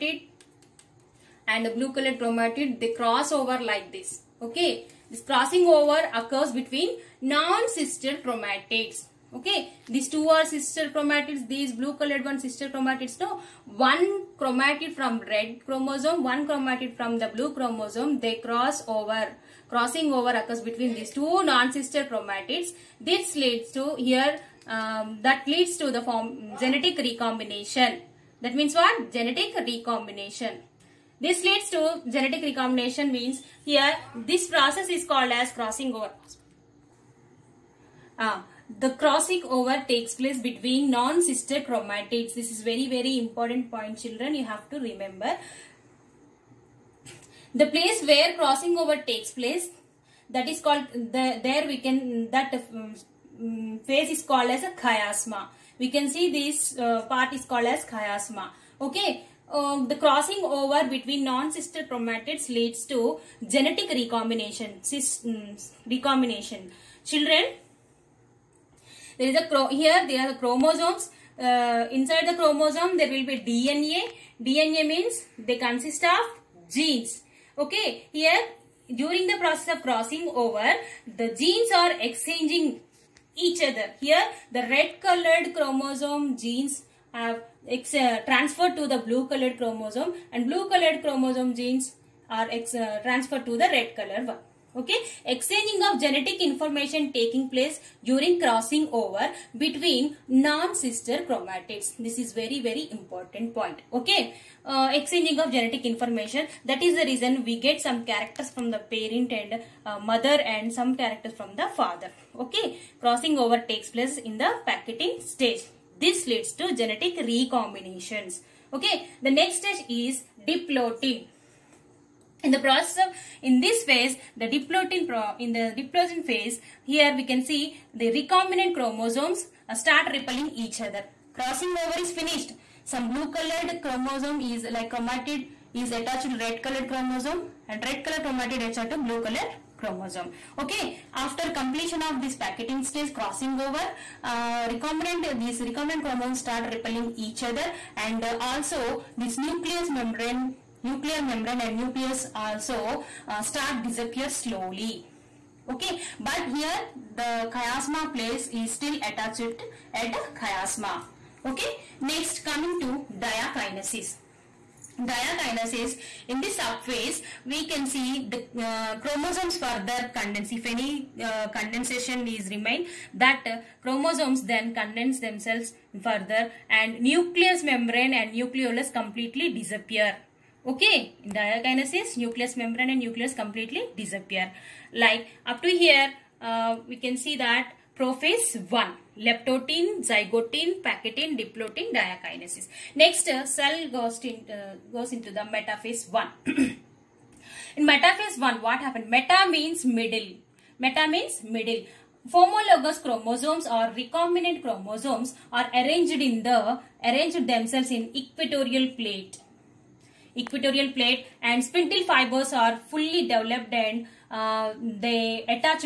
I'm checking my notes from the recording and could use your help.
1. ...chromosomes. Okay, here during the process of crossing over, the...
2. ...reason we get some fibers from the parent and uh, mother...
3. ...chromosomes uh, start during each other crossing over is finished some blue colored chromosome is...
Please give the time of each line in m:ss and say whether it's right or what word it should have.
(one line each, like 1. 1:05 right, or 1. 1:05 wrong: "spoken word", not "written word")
1. 1:16 wrong: "genes", not "chromosomes"
2. 1:47 wrong: "characters", not "fibers"
3. 2:08 wrong: "repelling", not "during".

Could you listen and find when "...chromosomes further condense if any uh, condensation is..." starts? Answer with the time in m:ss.
2:49.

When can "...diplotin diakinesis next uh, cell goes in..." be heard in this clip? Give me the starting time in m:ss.
3:11.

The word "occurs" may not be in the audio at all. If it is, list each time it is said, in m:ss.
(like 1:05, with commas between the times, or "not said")
0:06, 0:20.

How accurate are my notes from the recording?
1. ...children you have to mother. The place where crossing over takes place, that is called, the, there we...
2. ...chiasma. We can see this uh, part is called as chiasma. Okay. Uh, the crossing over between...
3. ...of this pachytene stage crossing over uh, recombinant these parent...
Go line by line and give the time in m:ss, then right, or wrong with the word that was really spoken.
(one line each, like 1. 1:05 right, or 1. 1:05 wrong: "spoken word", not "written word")
1. 0:43 wrong: "remember", not "mother"
2. 0:54 right
3. 2:22 wrong: "recombinant", not "parent".